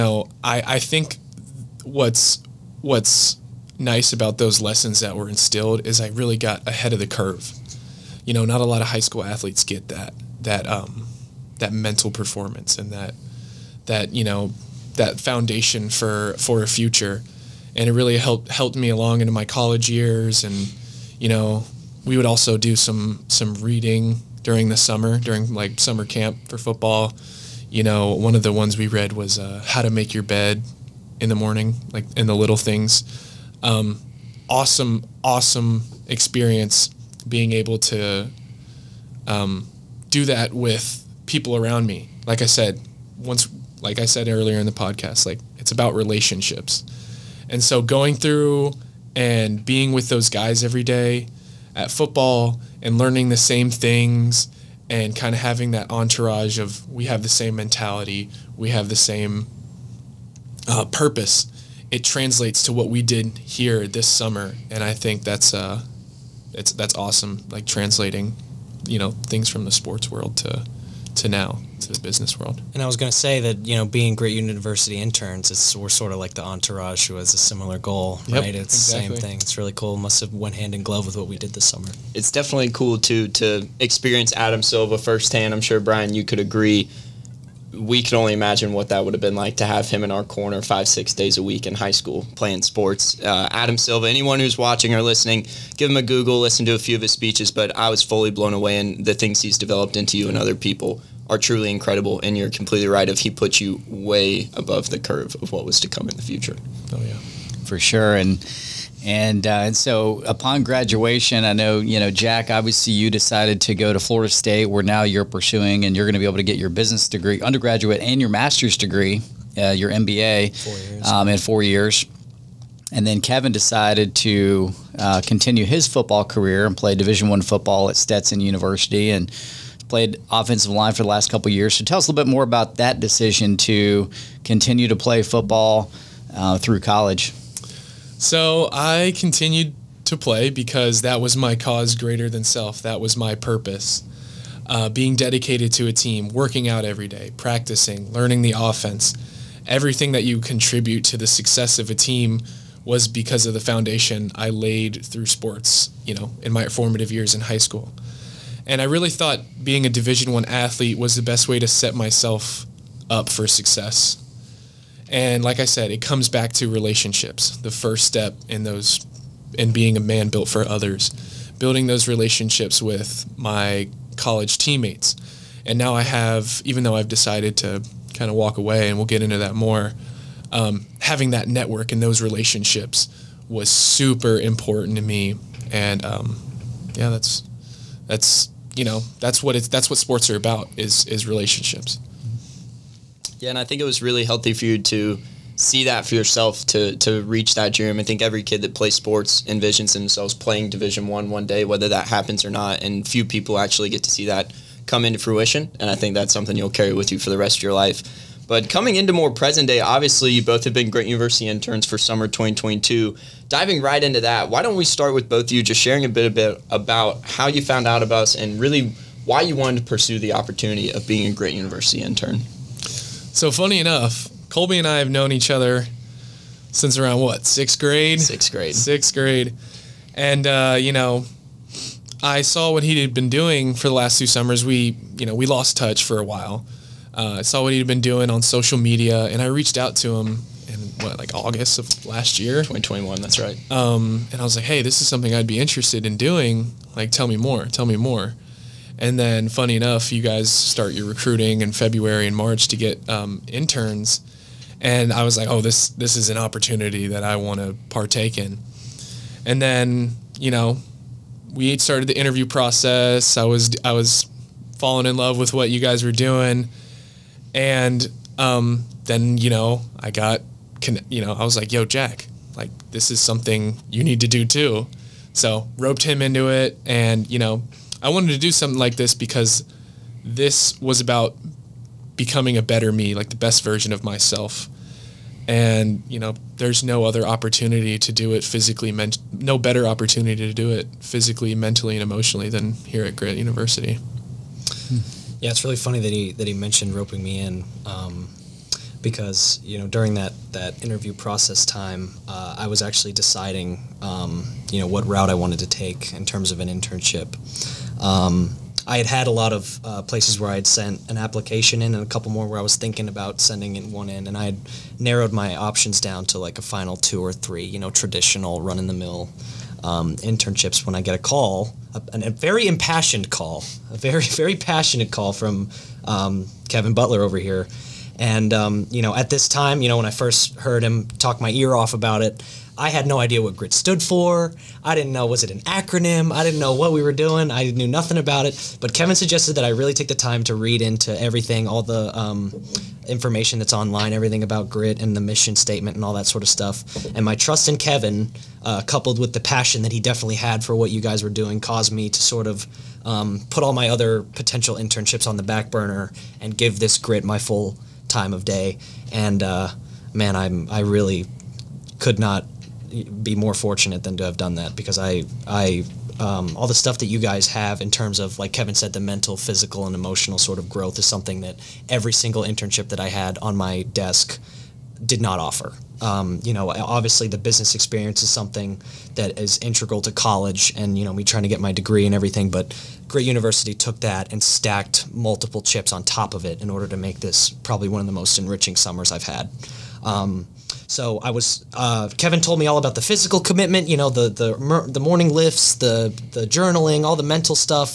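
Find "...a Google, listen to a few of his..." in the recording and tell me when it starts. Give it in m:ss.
1:35.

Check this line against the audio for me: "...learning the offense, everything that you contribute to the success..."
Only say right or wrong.
right.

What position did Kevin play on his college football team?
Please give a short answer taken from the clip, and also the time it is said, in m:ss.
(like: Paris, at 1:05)
offensive line, at 2:10.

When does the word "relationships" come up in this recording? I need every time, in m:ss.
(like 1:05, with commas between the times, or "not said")
0:45, 2:46, 2:52, 3:02, 3:11.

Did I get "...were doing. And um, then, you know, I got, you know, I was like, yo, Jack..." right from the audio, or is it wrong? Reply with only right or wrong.
right.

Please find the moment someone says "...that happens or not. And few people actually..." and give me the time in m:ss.
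3:21.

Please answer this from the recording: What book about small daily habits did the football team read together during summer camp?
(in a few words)
How to Make Your Bed.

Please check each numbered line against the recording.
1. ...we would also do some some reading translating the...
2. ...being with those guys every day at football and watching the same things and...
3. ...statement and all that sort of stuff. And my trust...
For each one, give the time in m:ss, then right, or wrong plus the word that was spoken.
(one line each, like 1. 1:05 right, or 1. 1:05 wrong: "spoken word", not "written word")
1. 0:22 wrong: "during", not "translating"
2. 0:49 wrong: "learning", not "watching"
3. 5:45 right.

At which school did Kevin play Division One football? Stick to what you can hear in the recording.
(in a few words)
Stetson University.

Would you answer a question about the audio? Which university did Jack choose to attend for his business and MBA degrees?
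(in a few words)
Florida State.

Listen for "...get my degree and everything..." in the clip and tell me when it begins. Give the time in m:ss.
6:21.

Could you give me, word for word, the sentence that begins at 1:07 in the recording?
Like translating, you know, things from the sports world to to now to the business world.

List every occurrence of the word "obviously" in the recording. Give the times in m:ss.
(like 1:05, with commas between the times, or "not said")
1:52, 3:29, 6:16.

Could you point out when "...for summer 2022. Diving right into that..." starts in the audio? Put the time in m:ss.
3:31.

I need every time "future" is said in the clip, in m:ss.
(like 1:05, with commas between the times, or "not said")
0:16, 1:46.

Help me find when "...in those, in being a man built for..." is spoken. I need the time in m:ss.
2:48.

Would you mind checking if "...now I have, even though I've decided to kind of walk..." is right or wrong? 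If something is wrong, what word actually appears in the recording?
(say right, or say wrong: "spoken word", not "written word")
right.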